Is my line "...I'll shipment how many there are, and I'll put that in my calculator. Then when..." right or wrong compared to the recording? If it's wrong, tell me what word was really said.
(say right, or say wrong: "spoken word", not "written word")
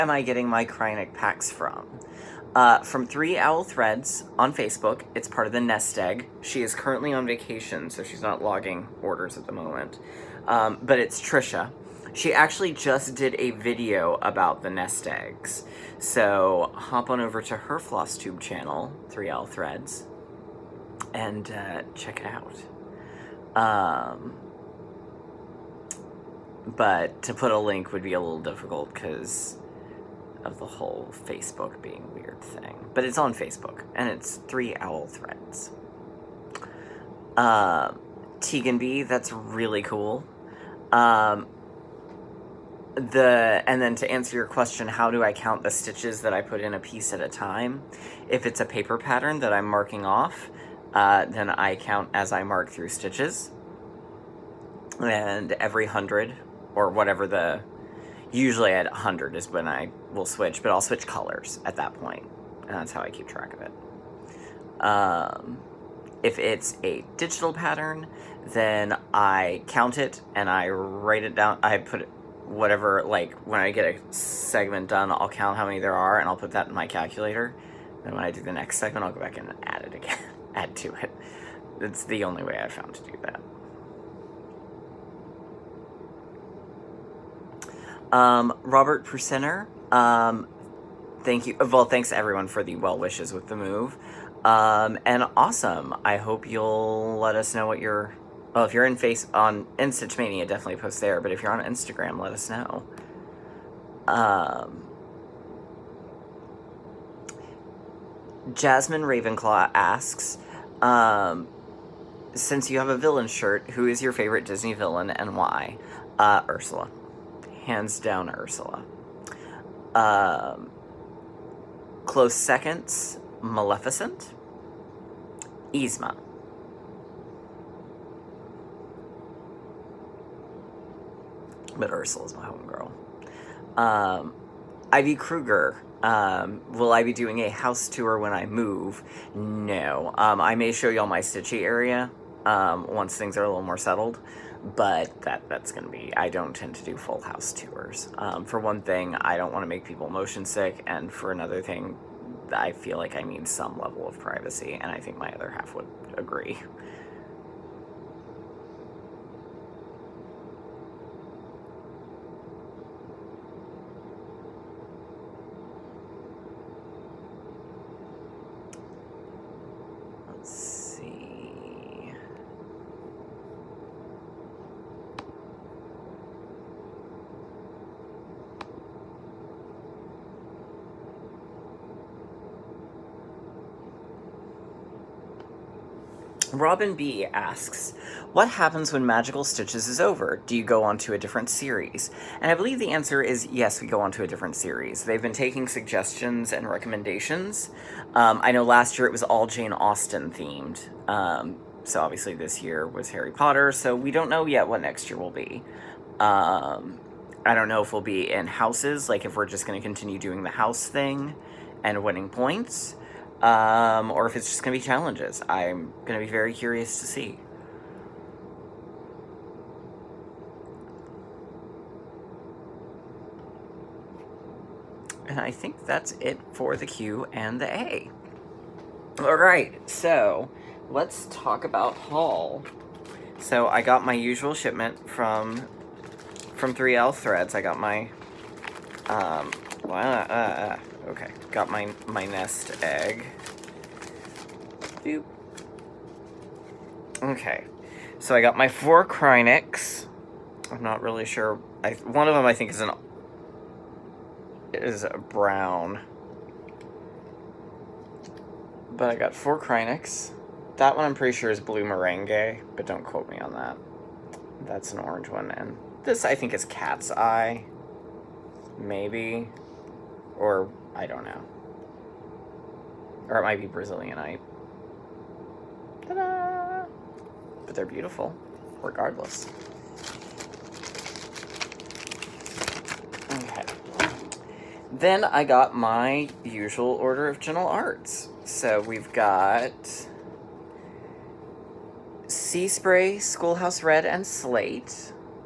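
wrong: "count", not "shipment".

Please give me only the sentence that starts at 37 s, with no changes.
Uh, Tegan B, that's really cool.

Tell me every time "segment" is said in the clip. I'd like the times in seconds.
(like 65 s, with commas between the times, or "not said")
74 s, 78 s.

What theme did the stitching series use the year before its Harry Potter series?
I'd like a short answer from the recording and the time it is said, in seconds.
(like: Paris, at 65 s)
Jane Austen, at 199 s.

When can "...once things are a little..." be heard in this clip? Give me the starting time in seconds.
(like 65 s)
142 s.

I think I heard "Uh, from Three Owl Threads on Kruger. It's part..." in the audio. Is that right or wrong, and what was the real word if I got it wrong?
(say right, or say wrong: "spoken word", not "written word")
wrong: "Facebook", not "Kruger".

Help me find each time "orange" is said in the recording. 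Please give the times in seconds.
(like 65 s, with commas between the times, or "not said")
264 s.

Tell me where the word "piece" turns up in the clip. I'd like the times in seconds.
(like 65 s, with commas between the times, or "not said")
46 s.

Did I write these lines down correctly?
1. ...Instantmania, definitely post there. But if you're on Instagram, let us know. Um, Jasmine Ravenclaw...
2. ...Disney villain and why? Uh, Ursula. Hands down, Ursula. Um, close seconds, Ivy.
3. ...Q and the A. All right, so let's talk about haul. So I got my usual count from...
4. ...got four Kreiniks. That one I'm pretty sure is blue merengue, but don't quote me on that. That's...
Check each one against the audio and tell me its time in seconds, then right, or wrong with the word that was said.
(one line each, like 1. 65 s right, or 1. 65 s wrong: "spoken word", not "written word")
1. 99 s right
2. 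114 s wrong: "Maleficent", not "Ivy"
3. 226 s wrong: "shipment", not "count"
4. 259 s right.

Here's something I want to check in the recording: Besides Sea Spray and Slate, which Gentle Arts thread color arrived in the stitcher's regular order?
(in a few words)
Schoolhouse Red.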